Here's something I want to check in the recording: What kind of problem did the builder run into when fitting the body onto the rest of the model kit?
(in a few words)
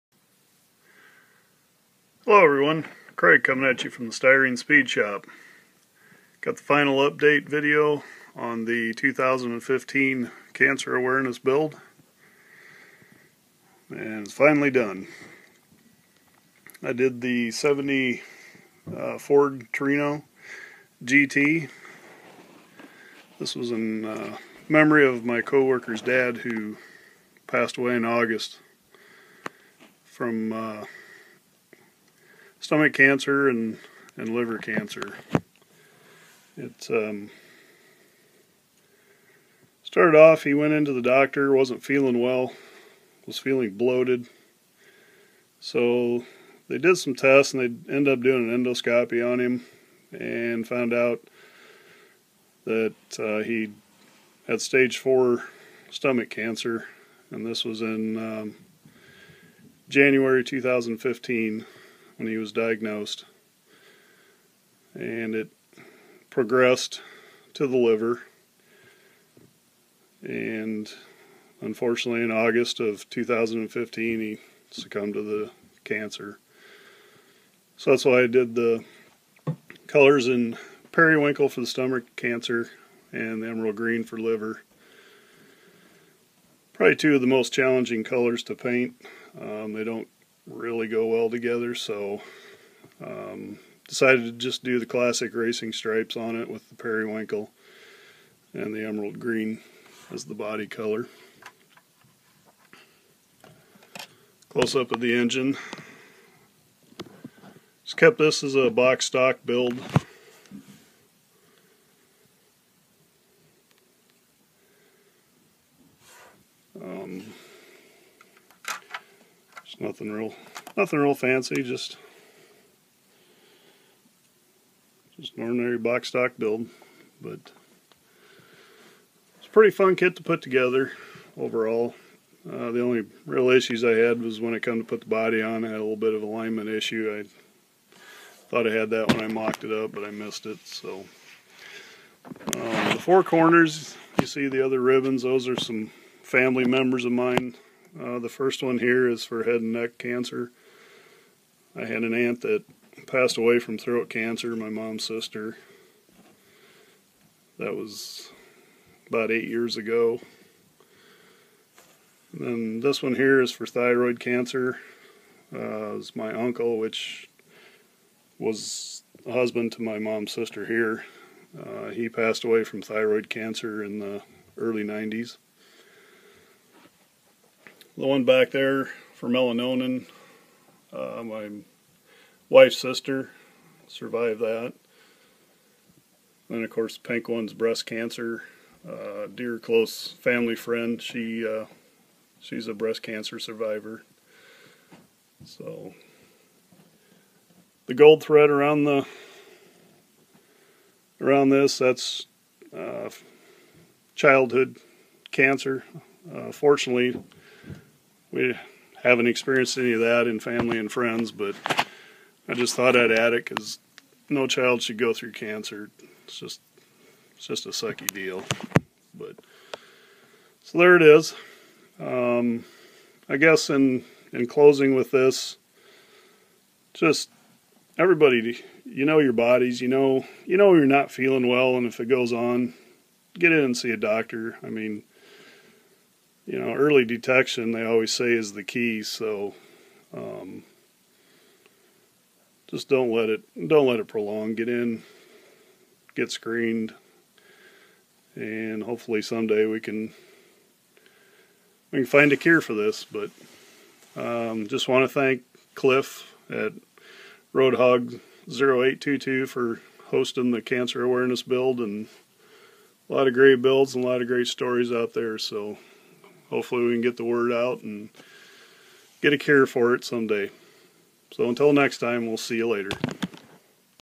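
alignment issue.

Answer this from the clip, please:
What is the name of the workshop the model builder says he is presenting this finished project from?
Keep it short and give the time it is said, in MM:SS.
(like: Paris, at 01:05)
Styrene Speed Shop, at 00:04.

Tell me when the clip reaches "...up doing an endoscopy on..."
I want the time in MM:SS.
00:48.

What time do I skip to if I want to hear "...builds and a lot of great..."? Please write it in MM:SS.
04:23.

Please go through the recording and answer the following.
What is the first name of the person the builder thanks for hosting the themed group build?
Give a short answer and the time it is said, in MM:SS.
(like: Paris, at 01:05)
Cliff, at 04:15.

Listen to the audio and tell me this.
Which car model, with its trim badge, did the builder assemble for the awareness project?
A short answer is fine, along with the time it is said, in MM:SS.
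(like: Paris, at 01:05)
Ford Torino GT, at 00:19.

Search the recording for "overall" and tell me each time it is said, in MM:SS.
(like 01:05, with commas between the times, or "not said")
02:11.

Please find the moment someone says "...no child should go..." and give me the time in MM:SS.
03:34.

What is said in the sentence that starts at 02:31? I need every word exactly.
I had an aunt that passed away from throat cancer, my mom's sister.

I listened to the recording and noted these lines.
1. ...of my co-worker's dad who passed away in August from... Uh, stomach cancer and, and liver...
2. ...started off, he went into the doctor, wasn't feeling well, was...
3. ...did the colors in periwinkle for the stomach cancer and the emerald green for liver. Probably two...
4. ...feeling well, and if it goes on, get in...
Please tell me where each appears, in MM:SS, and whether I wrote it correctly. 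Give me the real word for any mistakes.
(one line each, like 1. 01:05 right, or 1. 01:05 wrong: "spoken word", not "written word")
1. 00:25 right
2. 00:39 right
3. 01:18 right
4. 03:51 right.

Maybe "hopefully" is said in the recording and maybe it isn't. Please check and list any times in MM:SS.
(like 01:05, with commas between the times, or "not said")
04:08, 04:26.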